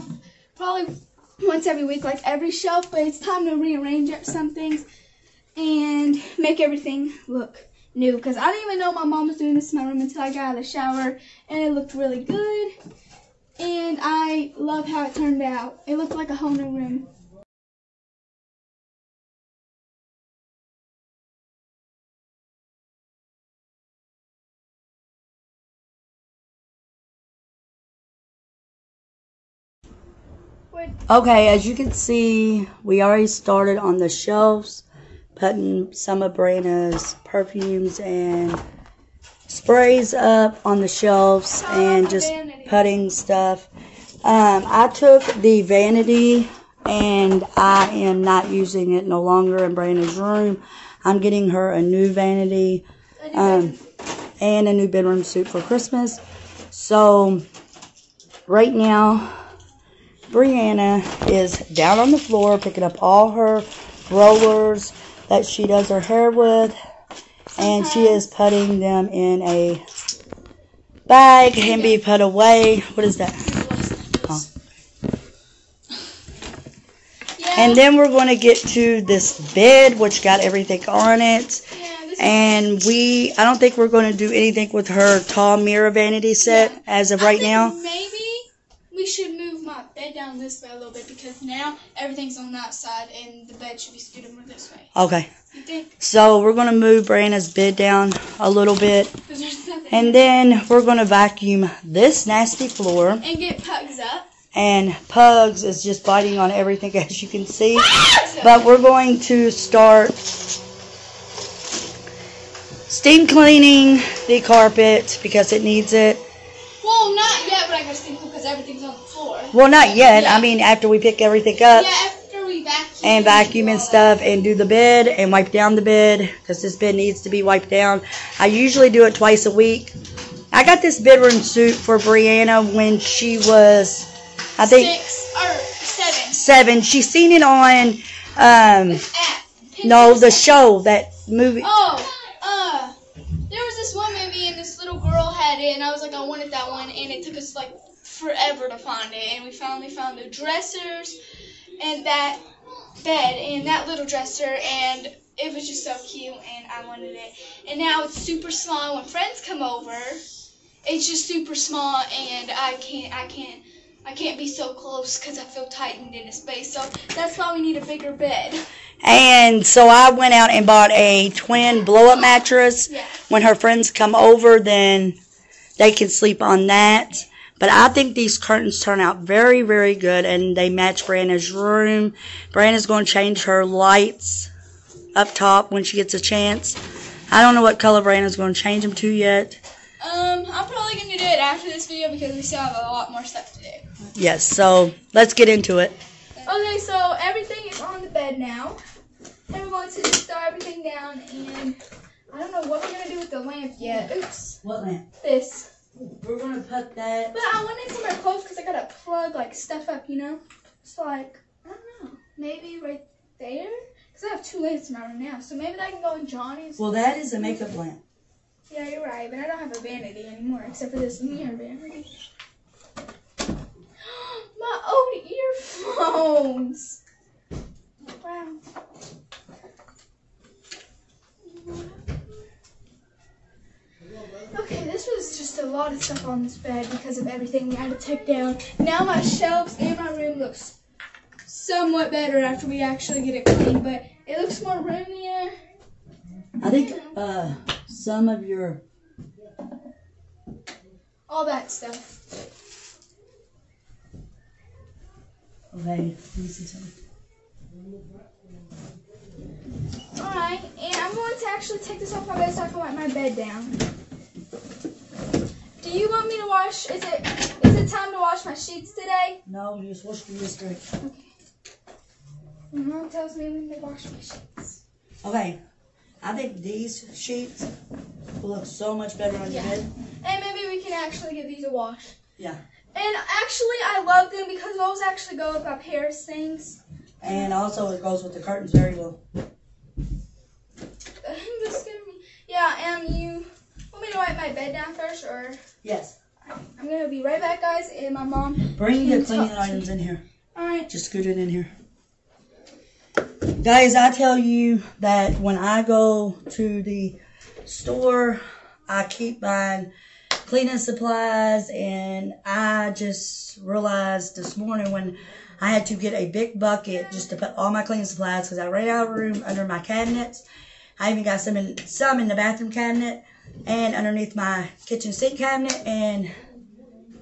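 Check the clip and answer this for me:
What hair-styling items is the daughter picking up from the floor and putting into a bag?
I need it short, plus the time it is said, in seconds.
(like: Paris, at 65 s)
Rollers, at 64 s.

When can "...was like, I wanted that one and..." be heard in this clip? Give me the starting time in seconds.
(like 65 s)
145 s.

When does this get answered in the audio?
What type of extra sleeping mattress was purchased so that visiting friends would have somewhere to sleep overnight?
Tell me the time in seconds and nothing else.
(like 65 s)
171 s.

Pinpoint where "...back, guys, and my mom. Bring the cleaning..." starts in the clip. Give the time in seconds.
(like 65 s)
297 s.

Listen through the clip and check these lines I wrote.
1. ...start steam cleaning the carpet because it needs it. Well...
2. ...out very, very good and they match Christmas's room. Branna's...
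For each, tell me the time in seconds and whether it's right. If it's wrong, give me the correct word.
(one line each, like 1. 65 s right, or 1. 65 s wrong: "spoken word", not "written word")
1. 109 s right
2. 179 s wrong: "Branna", not "Christmas".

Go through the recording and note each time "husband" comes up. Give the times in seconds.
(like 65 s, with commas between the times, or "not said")
not said.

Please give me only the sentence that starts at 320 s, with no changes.
I even got some in, some in the bathroom cabinet and underneath my kitchen sink cabinet.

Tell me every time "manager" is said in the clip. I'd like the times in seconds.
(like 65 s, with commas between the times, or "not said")
not said.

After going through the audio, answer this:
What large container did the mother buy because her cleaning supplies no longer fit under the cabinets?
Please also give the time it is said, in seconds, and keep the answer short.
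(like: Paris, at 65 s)
Big bucket, at 316 s.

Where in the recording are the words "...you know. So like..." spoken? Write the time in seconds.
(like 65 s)
210 s.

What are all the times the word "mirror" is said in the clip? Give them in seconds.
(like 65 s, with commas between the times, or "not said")
85 s, 221 s.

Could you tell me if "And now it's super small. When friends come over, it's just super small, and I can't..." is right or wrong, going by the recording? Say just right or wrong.
right.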